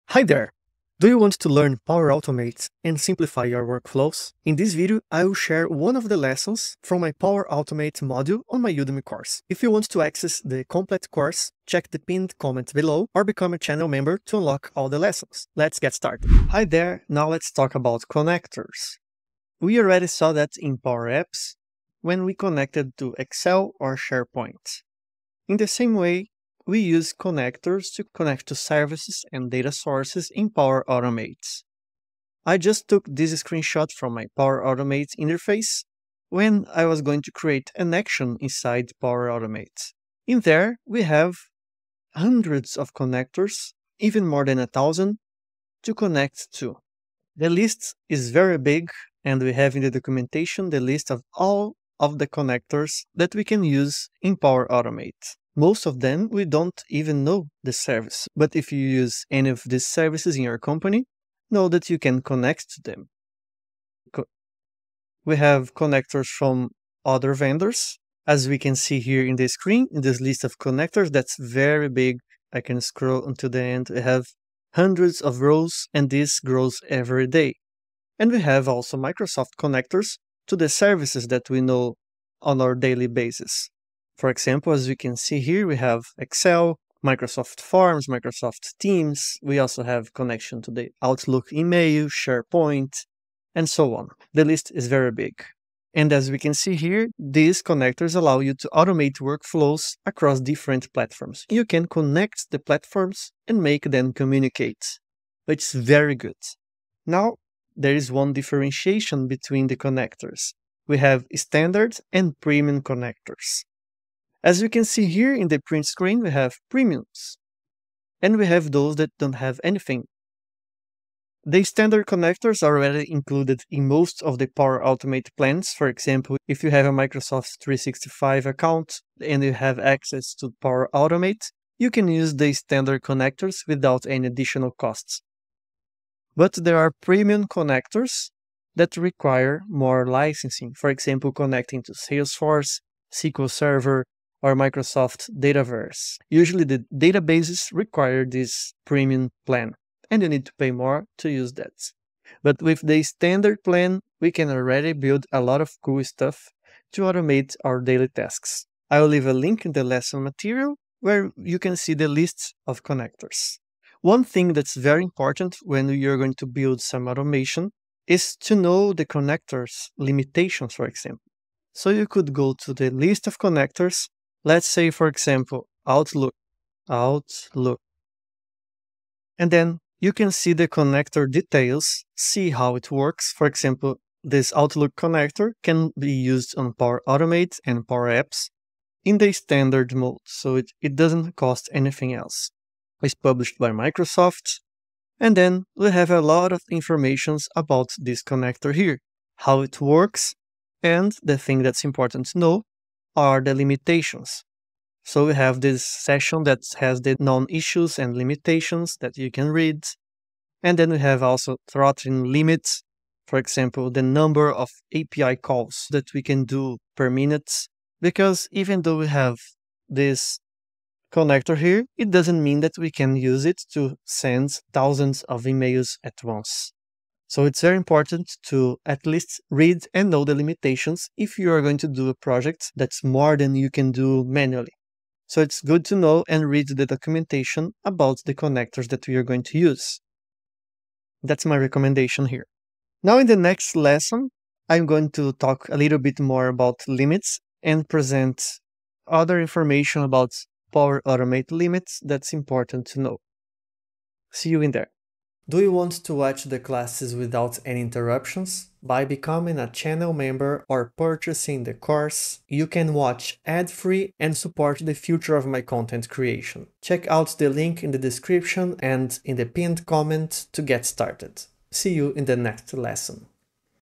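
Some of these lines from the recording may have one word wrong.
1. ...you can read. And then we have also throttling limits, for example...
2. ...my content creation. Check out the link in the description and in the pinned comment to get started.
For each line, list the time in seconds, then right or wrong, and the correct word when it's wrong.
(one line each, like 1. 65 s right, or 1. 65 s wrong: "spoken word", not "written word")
1. 209 s right
2. 265 s right.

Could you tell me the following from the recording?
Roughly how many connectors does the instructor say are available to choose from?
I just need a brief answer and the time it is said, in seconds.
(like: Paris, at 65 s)
more than a thousand, at 44 s.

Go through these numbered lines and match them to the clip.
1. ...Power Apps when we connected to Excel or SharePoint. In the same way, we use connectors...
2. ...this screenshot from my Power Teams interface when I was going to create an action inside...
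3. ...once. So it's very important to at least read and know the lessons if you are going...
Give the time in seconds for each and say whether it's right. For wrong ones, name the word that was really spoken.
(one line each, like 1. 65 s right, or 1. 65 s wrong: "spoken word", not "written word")
1. 20 s right
2. 33 s wrong: "Automate", not "Teams"
3. 226 s wrong: "limitations", not "lessons".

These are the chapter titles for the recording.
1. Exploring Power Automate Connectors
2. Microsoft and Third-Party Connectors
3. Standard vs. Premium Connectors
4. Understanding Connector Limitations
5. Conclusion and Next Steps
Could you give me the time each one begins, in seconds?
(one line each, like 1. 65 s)
1. 32 s
2. 78 s
3. 106 s
4. 163 s
5. 242 s.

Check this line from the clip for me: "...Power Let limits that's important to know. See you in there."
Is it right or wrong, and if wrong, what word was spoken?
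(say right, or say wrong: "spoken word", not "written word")
wrong: "Automate", not "Let".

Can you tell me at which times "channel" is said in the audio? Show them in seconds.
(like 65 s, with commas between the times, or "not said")
13 s, 259 s.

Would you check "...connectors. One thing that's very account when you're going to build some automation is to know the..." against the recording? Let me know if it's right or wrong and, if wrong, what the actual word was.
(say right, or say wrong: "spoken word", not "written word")
wrong: "important", not "account".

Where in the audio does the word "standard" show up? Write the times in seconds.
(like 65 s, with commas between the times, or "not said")
111 s, 121 s, 132 s, 153 s, 189 s.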